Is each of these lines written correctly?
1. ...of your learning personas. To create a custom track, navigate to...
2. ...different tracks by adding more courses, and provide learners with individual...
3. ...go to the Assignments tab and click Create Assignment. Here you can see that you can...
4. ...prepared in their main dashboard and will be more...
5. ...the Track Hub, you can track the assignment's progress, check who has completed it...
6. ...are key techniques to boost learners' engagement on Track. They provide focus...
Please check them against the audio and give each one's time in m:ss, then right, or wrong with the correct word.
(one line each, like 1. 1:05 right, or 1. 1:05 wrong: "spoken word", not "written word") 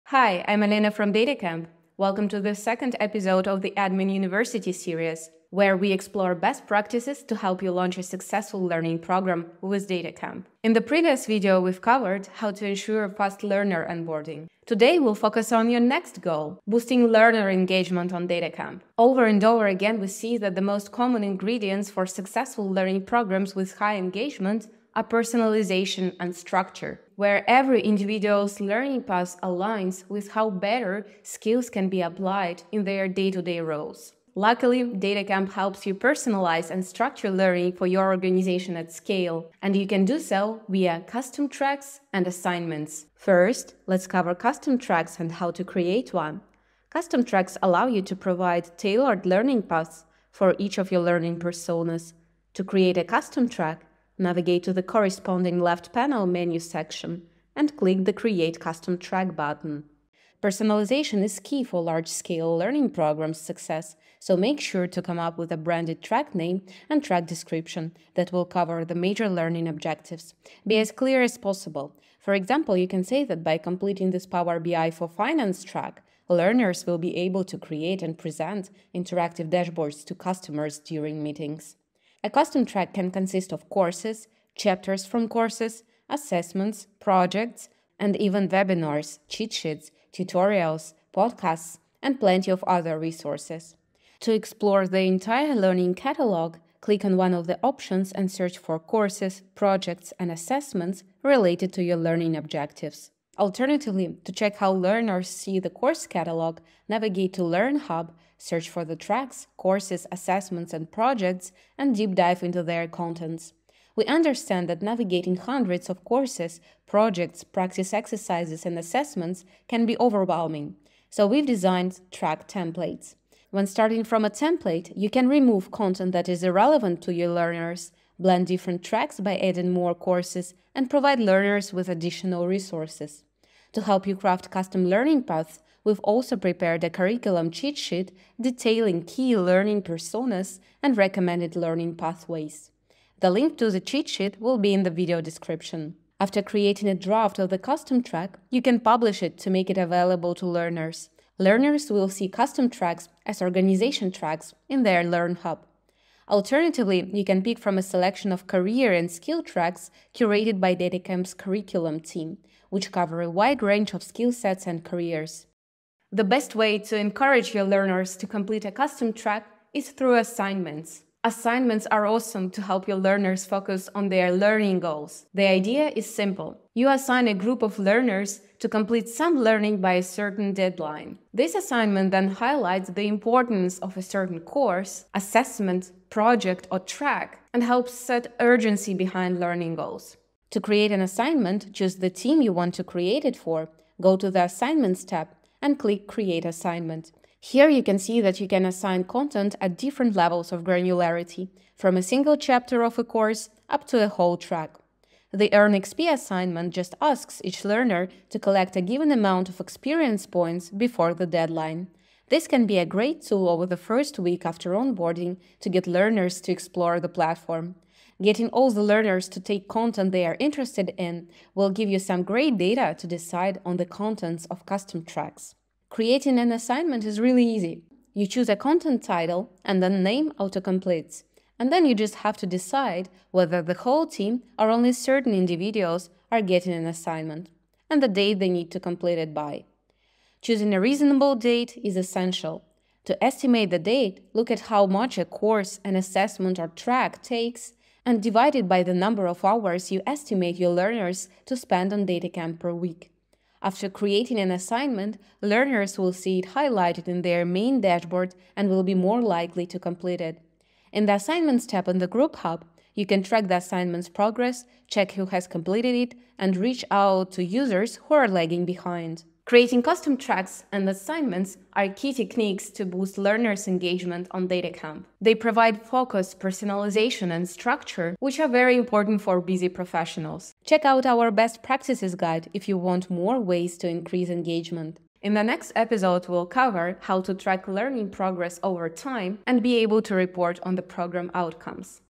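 1. 0:50 right
2. 2:08 wrong: "additional", not "individual"
3. 3:14 right
4. 4:16 wrong: "highlighted", not "prepared"
5. 4:21 wrong: "Group", not "Track"
6. 4:31 wrong: "DataCamp", not "Track".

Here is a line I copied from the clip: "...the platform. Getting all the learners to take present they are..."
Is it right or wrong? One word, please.
wrong.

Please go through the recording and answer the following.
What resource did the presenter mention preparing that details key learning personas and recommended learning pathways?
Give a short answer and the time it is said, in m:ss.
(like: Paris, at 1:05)
Curriculum cheat sheet, at 2:16.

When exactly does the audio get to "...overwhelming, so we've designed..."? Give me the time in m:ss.
1:59.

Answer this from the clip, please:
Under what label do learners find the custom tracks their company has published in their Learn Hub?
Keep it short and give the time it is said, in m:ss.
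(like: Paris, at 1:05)
Organization tracks, at 2:33.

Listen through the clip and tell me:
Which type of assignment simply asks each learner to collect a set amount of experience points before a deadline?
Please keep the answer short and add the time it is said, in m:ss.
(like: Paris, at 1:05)
Earn XP, at 3:25.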